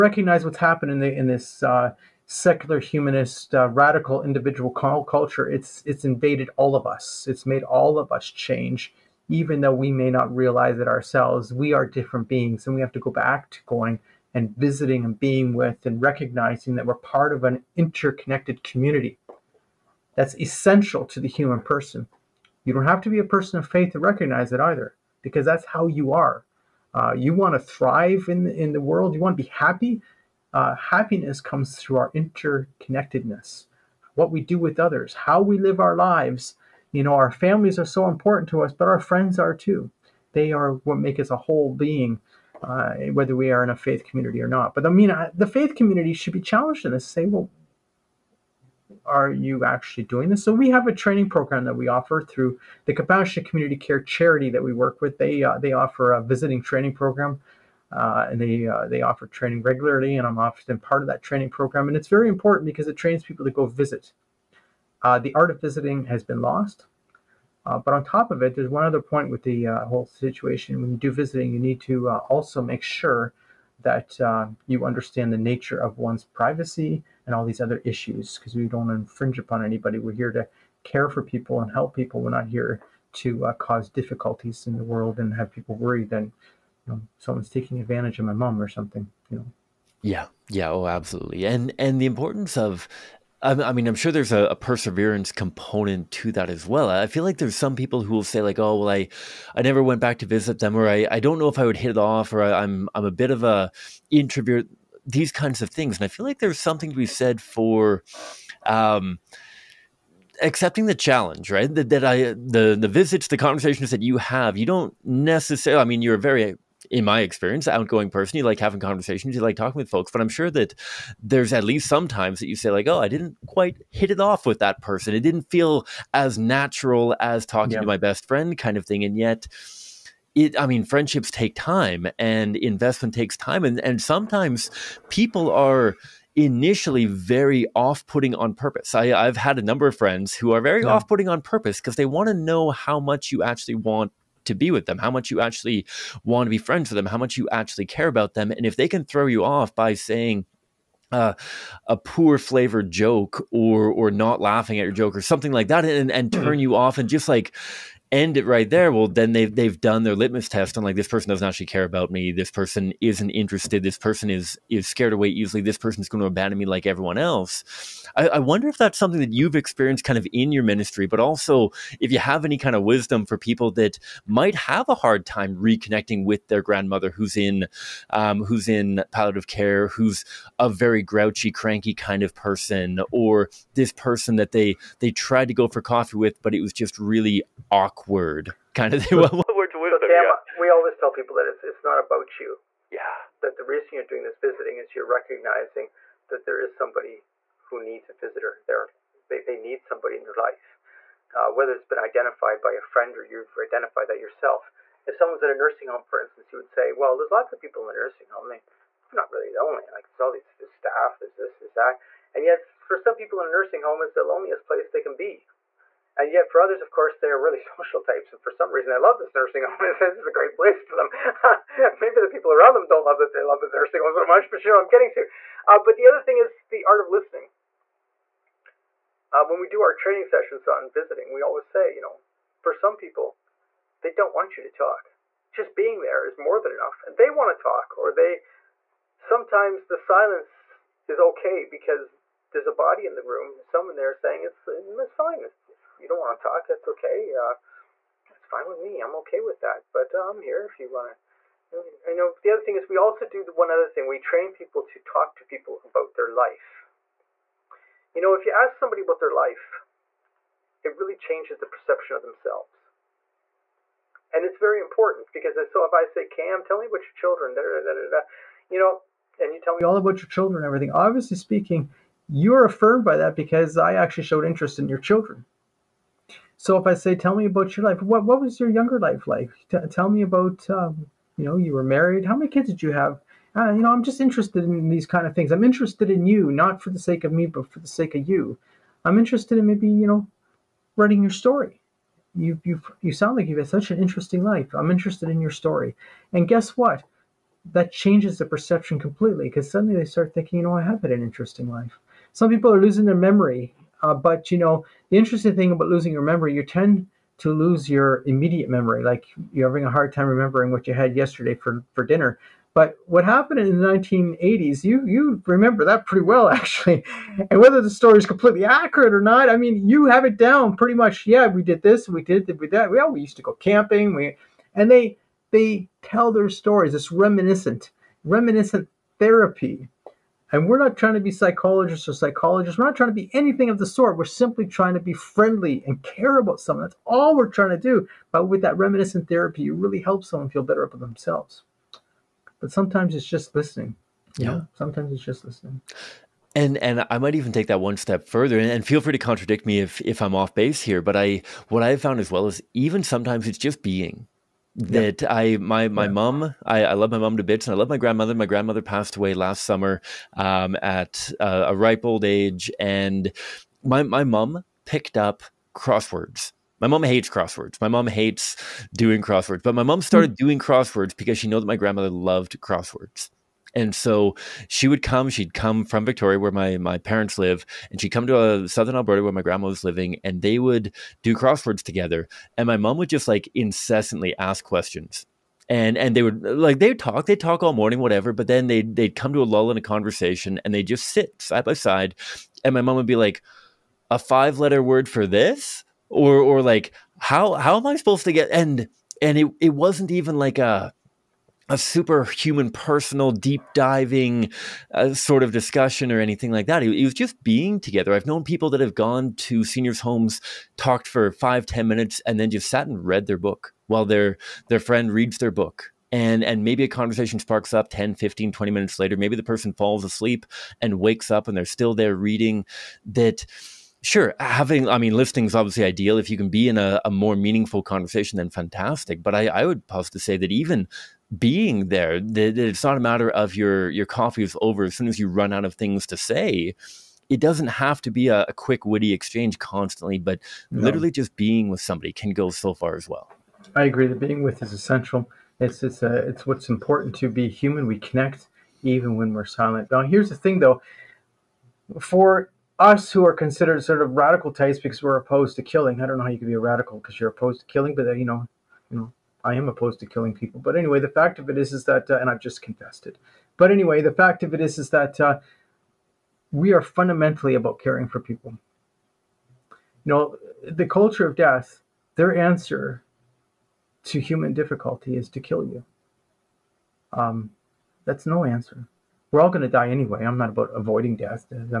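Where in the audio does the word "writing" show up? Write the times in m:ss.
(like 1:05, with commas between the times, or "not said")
4:50.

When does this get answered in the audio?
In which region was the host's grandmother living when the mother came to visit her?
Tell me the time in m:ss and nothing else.
6:18.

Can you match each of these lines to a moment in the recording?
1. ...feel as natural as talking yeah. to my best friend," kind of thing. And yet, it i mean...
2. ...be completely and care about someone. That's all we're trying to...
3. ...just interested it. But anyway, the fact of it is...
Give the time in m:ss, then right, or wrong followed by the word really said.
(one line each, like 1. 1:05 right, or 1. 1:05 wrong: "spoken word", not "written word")
1. 2:05 right
2. 5:34 wrong: "friendly", not "completely"
3. 7:42 wrong: "confessed", not "interested".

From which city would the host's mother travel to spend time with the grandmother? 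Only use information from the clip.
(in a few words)
Victoria.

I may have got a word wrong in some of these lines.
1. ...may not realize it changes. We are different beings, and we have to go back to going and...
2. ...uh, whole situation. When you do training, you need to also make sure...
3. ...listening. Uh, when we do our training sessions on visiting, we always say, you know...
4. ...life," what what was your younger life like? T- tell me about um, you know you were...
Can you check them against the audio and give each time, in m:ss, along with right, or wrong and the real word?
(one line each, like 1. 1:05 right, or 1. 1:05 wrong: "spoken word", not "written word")
1. 0:09 wrong: "ourselves", not "changes"
2. 1:09 wrong: "visiting", not "training"
3. 3:47 right
4. 4:37 right.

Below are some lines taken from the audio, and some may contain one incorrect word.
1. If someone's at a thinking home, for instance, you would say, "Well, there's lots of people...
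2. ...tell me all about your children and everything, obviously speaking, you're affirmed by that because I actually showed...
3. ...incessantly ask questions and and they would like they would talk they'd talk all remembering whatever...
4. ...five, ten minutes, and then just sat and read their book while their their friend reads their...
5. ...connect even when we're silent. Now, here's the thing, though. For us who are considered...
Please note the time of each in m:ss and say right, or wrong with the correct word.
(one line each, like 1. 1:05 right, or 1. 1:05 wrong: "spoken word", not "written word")
1. 3:25 wrong: "nursing", not "thinking"
2. 4:29 right
3. 6:23 wrong: "morning", not "remembering"
4. 6:51 right
5. 7:27 right.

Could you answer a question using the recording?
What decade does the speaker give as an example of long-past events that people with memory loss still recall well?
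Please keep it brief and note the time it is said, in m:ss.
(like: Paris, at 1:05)
the 1980s, at 5:13.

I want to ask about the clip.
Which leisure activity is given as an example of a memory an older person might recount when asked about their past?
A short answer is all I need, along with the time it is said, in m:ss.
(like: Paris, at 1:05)
camping, at 5:23.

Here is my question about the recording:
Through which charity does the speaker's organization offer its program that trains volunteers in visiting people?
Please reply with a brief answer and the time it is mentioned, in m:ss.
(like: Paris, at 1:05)
Compassionate Community Care, at 0:52.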